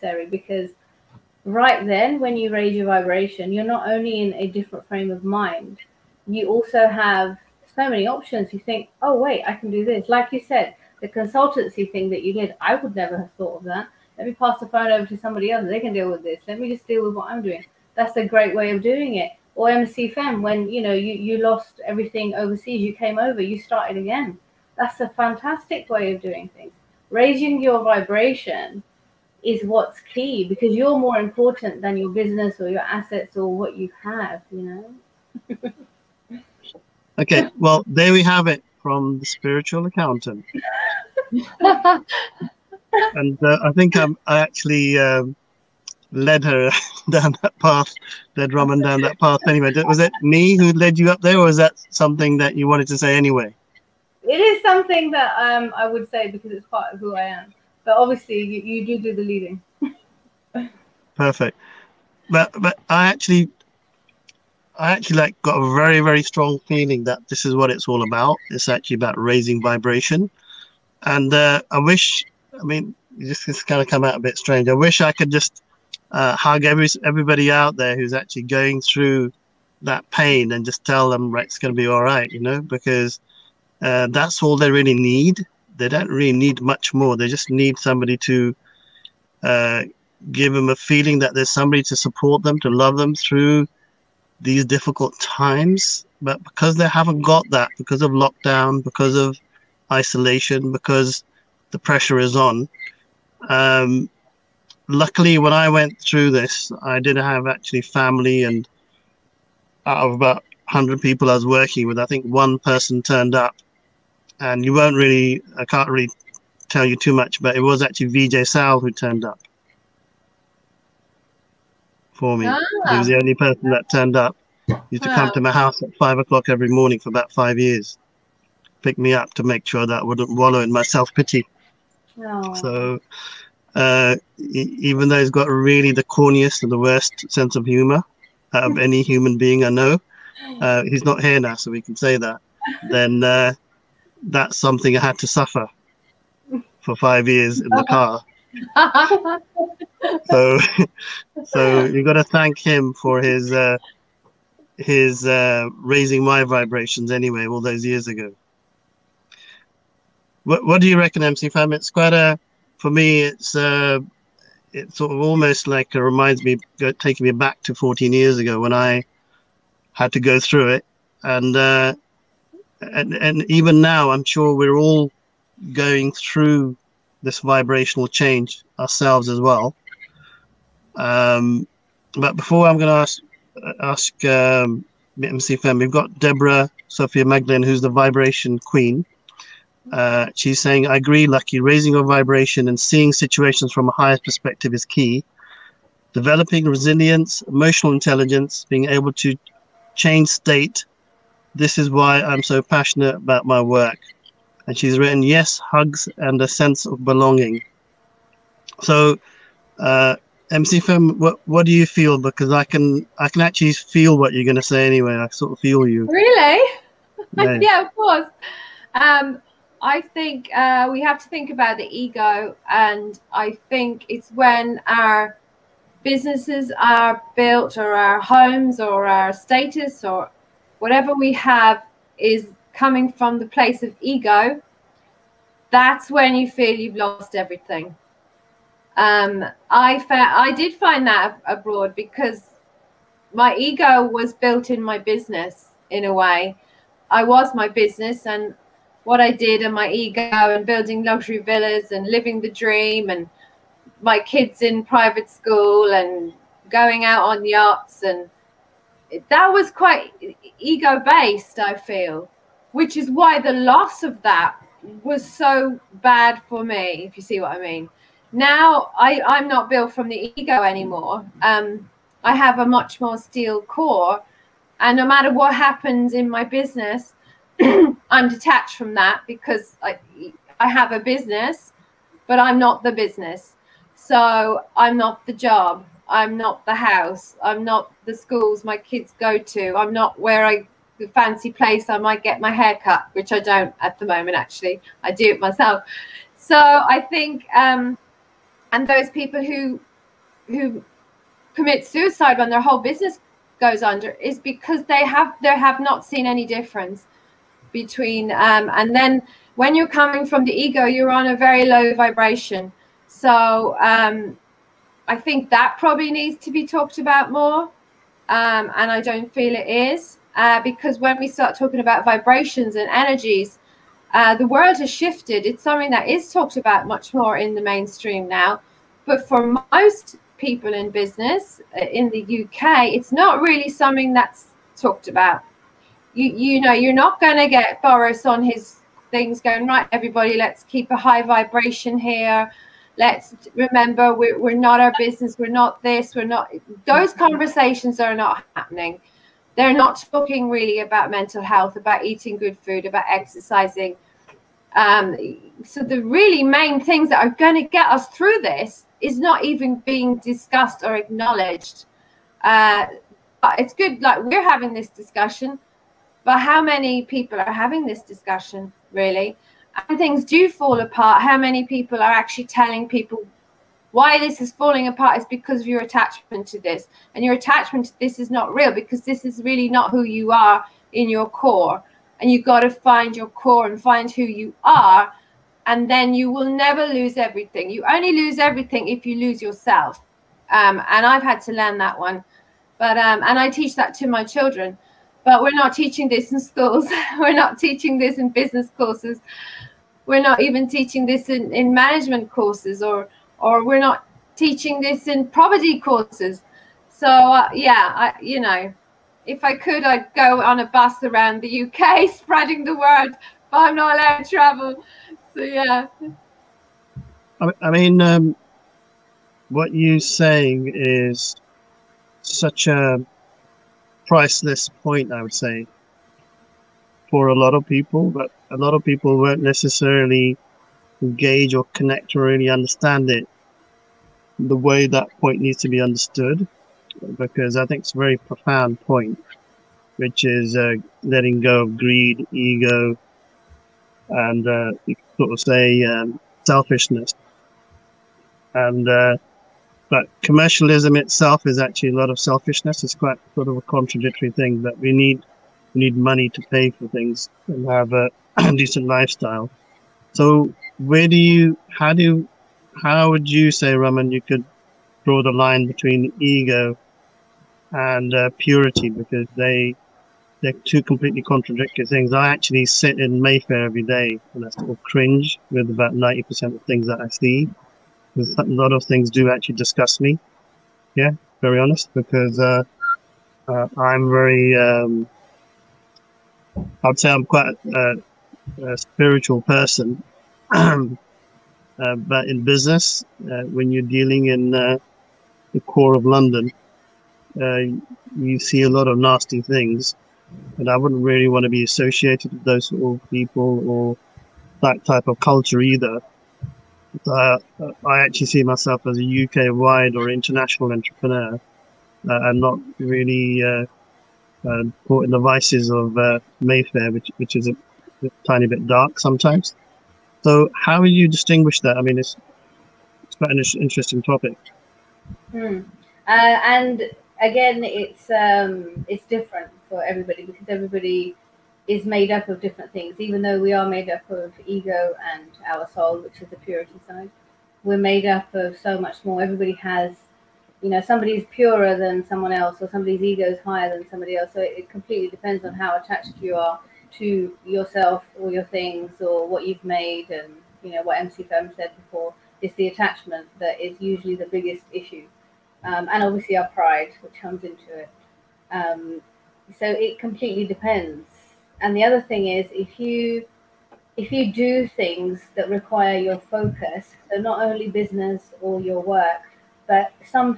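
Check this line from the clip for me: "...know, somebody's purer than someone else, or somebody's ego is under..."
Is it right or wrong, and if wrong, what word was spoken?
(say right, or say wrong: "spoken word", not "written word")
wrong: "higher", not "under".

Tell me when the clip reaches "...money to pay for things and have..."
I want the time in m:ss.
7:35.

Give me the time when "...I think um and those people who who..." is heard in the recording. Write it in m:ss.
4:56.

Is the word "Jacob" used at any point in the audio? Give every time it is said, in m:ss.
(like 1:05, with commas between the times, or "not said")
not said.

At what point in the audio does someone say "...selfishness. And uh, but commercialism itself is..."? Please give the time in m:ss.
7:26.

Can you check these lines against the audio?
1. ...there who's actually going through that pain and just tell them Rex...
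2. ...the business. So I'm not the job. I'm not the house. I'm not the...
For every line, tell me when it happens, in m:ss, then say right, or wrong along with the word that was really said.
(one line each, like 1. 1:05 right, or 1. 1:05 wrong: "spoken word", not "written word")
1. 1:17 right
2. 4:42 right.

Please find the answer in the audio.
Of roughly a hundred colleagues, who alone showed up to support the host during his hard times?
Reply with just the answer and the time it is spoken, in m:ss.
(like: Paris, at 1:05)
VJ Sal, at 1:58.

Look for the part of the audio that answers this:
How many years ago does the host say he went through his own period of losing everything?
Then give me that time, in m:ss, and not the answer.
2:47.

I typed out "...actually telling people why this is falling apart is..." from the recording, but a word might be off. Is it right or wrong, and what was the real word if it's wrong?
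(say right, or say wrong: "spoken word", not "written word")
right.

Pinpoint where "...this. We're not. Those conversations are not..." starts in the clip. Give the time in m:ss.
5:45.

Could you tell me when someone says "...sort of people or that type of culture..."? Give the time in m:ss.
8:22.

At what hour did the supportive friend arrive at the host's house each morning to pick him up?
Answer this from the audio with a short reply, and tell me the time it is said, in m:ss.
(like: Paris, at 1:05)
5 o'clock, at 2:05.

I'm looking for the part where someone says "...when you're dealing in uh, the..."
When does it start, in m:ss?
8:13.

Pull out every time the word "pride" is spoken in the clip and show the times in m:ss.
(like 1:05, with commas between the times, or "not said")
9:16.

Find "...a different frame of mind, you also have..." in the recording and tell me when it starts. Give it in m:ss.
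0:04.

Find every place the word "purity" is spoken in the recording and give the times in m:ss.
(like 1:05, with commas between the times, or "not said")
7:48, 8:56.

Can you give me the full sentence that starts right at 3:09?
Uh, she's saying, I agree, Lakhi.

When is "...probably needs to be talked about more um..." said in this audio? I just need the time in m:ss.
5:15.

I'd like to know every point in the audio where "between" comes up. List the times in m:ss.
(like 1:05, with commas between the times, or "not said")
5:07, 7:45.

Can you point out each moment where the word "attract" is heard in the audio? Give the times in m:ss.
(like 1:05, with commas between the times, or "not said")
not said.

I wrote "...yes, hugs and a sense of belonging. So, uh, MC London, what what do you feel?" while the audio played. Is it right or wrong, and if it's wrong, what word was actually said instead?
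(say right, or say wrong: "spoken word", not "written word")
wrong: "Femme", not "London".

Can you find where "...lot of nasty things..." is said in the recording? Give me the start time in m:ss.
8:18.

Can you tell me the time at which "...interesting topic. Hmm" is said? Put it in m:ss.
8:43.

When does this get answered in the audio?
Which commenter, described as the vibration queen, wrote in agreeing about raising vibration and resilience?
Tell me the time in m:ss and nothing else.
3:06.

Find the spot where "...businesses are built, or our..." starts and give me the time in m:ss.
3:46.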